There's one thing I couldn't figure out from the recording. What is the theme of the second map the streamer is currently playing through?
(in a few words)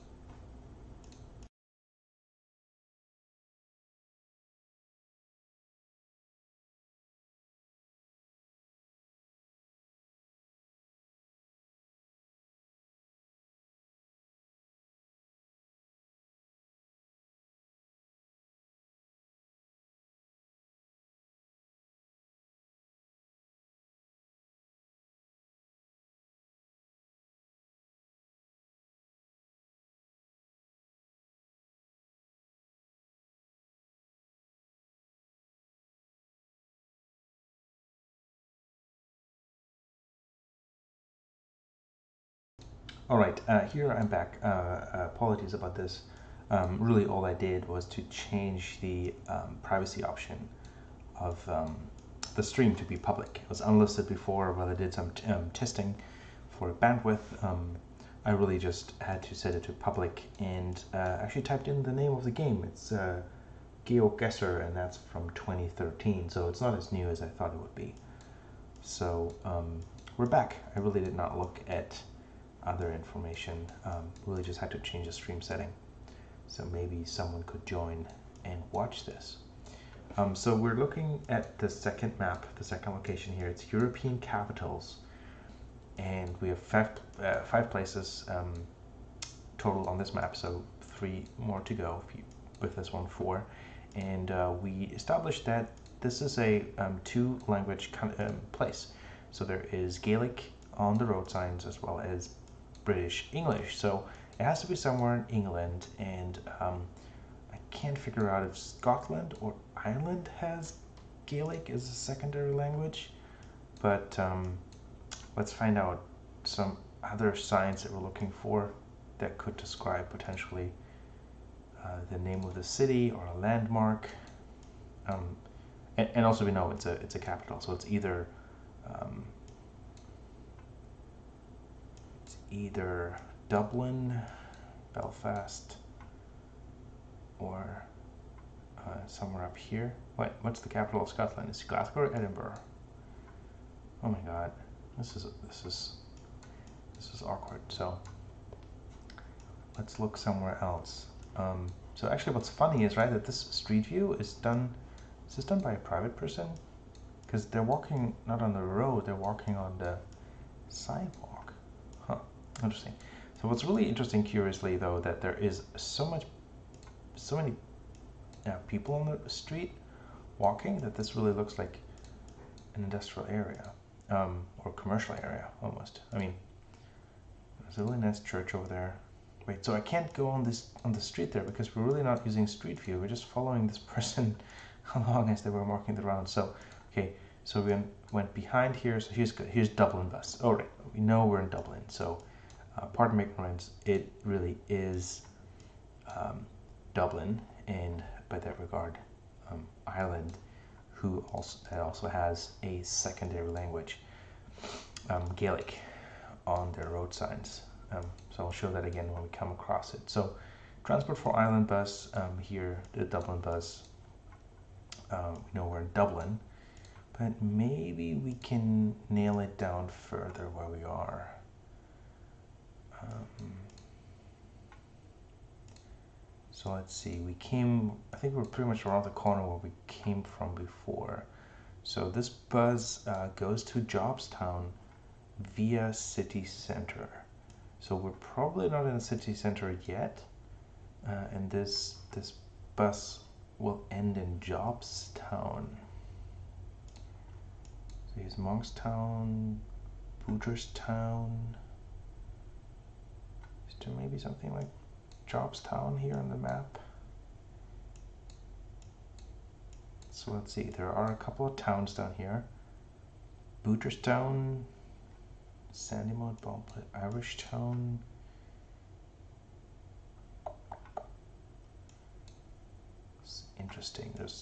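European capitals.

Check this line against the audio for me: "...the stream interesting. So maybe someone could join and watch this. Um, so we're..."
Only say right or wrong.
wrong.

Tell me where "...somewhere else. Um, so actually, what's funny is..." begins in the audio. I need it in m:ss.
2:30.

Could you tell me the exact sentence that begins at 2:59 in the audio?
Wait, so I can't go on this on the street there because we're really not using street view.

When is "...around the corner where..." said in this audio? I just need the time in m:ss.
3:48.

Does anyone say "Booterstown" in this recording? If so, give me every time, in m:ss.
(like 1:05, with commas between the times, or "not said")
4:10, 4:23.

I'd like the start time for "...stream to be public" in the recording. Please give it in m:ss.
0:52.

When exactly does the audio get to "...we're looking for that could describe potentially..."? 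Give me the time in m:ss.
1:57.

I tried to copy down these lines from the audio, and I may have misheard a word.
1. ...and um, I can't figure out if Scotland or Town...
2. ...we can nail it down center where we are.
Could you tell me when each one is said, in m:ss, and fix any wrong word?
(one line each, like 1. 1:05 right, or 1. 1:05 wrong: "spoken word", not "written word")
1. 1:45 wrong: "Ireland", not "Town"
2. 3:38 wrong: "further", not "center".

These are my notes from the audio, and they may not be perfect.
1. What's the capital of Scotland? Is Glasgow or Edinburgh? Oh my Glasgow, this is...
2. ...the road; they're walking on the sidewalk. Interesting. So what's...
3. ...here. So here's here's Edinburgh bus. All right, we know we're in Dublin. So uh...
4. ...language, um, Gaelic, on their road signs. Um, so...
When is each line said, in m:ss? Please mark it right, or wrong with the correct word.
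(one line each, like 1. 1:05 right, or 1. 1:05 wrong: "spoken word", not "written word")
1. 2:20 wrong: "God", not "Glasgow"
2. 2:38 right
3. 3:08 wrong: "Dublin", not "Edinburgh"
4. 3:23 right.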